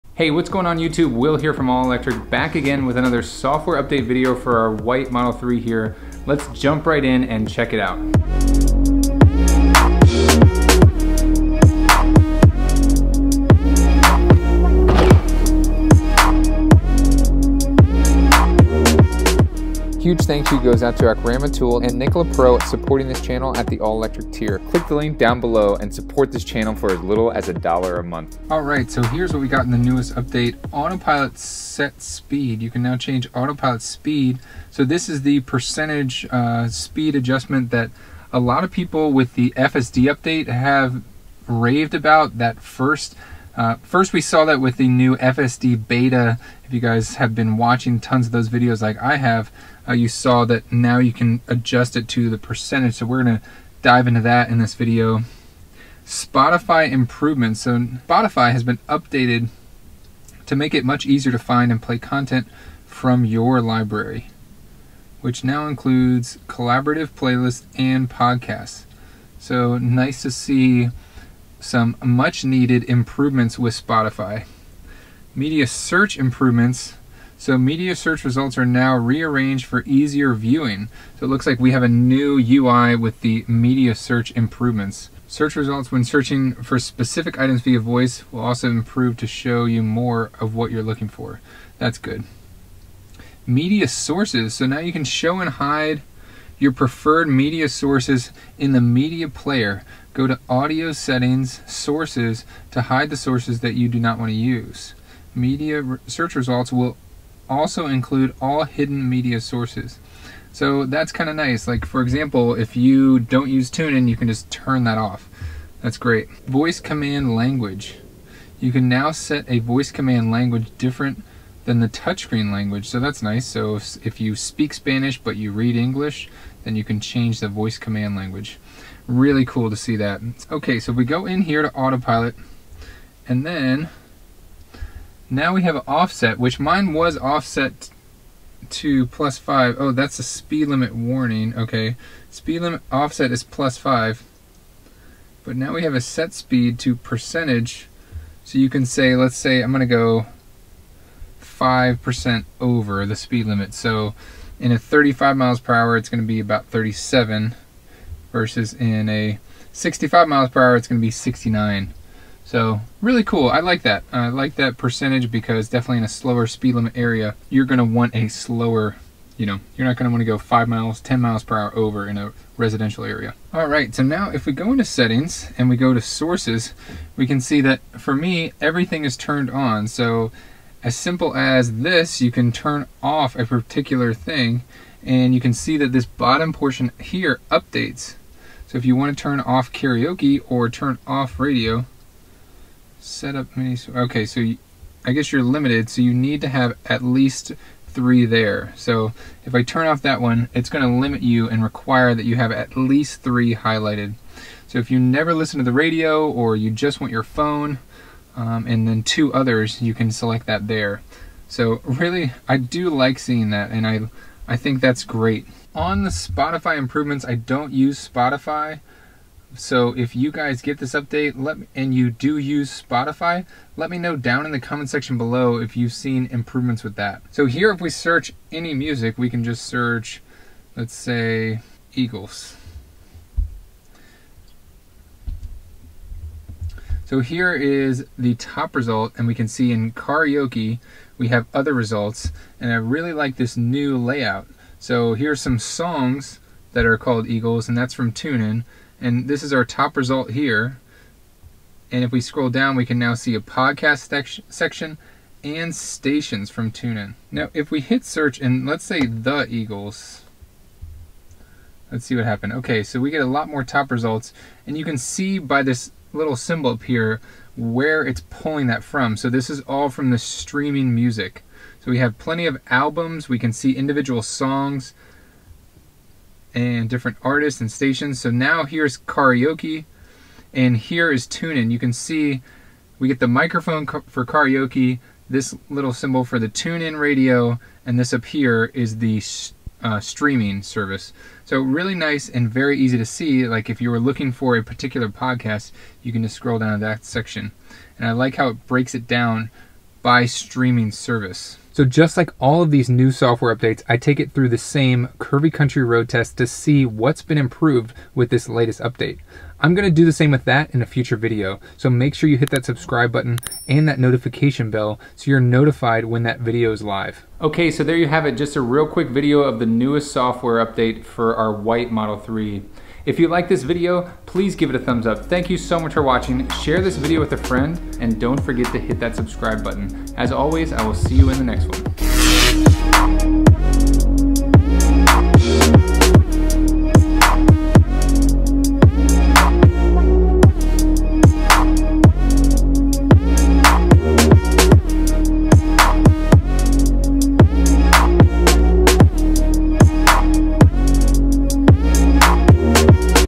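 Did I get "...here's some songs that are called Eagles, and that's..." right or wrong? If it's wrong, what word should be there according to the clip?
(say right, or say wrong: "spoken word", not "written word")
right.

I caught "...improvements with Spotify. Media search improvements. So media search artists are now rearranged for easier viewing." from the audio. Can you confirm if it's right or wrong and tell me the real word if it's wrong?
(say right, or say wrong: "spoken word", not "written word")
wrong: "results", not "artists".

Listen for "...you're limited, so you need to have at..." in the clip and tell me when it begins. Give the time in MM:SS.
03:15.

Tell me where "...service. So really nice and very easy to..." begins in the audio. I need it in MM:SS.
04:50.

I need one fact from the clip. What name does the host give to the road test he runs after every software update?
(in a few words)
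Curvy Country Road test.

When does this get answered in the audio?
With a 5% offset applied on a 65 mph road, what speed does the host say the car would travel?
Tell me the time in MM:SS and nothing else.
02:41.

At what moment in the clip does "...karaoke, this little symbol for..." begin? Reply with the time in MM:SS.
04:44.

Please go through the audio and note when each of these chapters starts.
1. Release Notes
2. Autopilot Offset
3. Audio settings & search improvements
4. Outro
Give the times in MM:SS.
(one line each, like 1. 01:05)
1. 00:28
2. 02:10
3. 02:53
4. 05:01.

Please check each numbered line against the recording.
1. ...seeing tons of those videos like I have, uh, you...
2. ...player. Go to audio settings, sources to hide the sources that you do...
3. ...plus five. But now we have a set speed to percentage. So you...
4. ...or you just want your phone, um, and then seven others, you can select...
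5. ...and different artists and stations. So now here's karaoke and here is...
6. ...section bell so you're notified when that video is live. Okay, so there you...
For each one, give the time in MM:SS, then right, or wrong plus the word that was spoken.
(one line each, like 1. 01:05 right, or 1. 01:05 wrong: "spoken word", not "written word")
1. 00:47 wrong: "watching", not "seeing"
2. 01:39 right
3. 02:23 right
4. 03:26 wrong: "two", not "seven"
5. 04:36 right
6. 05:13 wrong: "notification", not "section".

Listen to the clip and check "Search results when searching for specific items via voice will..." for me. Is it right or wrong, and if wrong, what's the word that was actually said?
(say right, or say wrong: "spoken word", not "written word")
right.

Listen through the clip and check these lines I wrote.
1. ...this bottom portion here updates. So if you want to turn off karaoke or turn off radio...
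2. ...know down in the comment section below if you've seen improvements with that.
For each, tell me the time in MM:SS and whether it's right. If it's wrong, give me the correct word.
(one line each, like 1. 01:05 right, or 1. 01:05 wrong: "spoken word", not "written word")
1. 03:05 right
2. 03:43 right.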